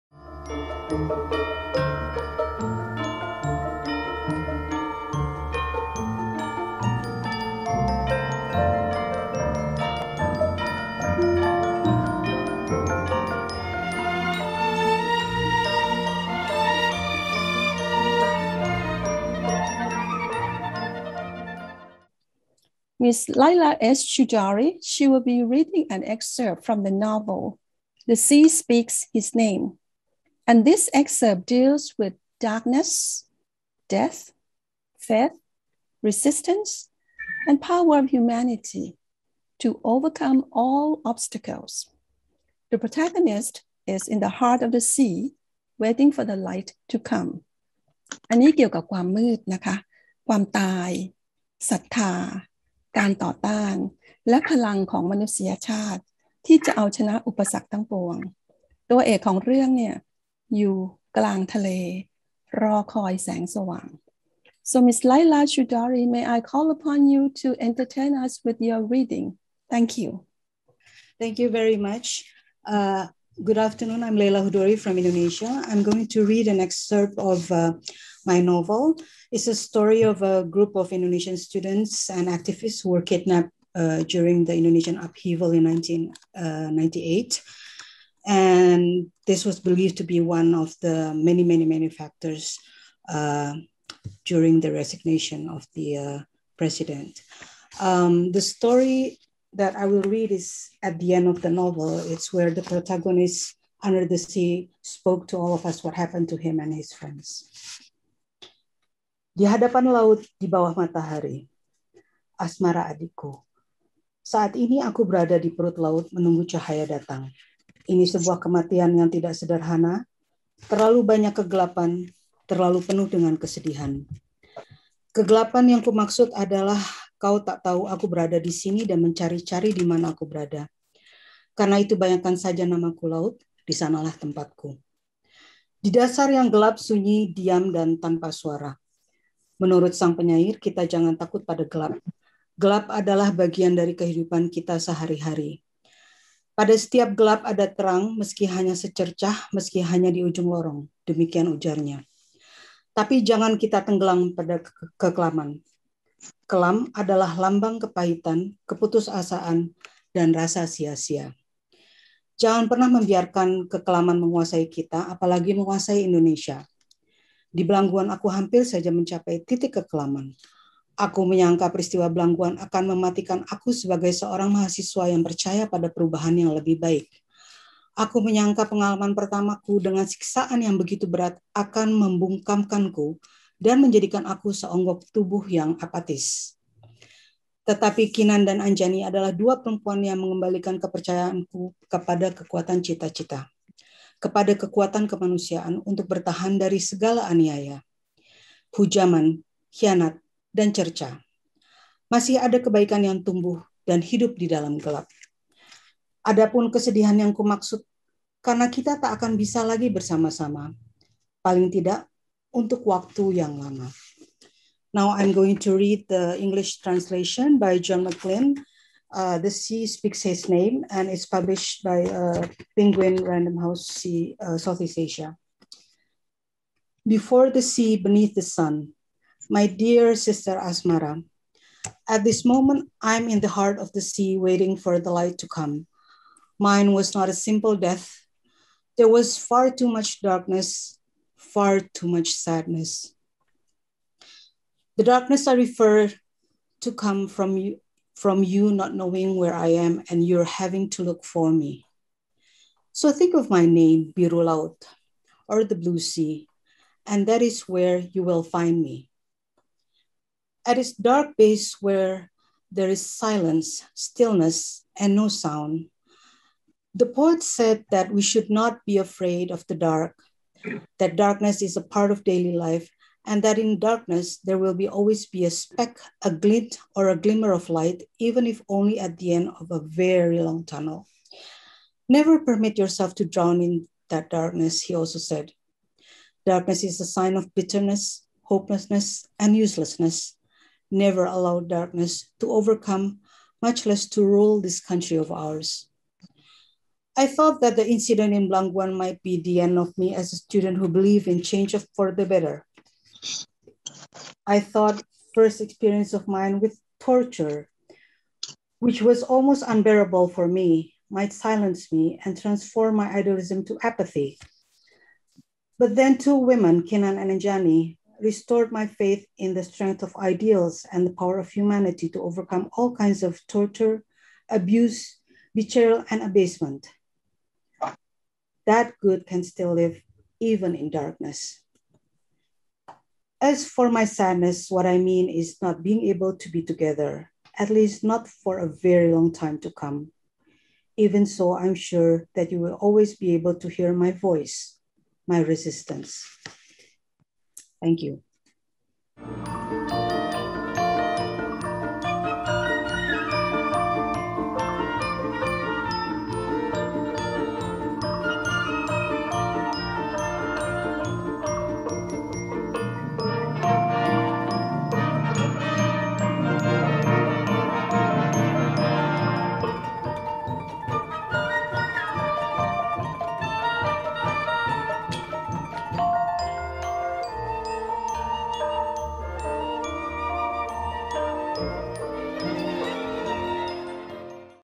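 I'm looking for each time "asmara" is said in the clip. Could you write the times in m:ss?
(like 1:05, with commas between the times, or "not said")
1:52, 3:50.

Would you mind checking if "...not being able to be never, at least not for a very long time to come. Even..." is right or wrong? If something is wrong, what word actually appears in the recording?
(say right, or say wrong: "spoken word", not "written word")
wrong: "together", not "never".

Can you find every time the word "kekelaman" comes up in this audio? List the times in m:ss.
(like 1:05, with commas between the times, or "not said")
2:34, 2:43, 2:49.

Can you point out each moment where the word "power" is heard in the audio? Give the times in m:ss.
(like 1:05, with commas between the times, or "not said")
0:37, 5:21.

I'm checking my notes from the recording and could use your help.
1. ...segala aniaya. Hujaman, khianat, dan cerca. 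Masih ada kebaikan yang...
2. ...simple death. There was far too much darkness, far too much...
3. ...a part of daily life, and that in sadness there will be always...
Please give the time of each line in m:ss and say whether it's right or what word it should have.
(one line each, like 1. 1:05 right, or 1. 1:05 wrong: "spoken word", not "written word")
1. 3:16 right
2. 3:57 right
3. 4:31 wrong: "darkness", not "sadness".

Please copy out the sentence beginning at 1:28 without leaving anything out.
And this was believed to be one of the many, many, many factors uh, during the resignation of the uh, president.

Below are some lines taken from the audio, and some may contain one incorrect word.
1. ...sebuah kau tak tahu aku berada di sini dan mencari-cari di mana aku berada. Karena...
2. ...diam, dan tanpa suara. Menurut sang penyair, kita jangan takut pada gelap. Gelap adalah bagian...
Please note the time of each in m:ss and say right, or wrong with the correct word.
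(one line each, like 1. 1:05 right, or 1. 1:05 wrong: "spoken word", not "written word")
1. 2:06 wrong: "adalah", not "sebuah"
2. 2:17 right.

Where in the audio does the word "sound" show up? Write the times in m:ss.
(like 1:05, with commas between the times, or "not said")
4:25.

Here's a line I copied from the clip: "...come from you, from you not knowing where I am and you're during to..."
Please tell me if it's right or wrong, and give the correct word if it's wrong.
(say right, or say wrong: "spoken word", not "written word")
wrong: "having", not "during".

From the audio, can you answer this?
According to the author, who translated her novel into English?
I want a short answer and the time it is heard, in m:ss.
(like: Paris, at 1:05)
John McLean, at 3:37.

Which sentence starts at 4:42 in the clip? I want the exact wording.
Never permit yourself to drown in that darkness, he also said.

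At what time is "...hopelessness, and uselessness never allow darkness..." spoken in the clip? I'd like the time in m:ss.
4:48.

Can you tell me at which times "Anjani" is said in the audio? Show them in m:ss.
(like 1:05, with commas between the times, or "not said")
3:08, 5:17.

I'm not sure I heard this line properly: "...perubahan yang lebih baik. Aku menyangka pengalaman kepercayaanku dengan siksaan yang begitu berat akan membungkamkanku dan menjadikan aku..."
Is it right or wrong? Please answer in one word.
wrong.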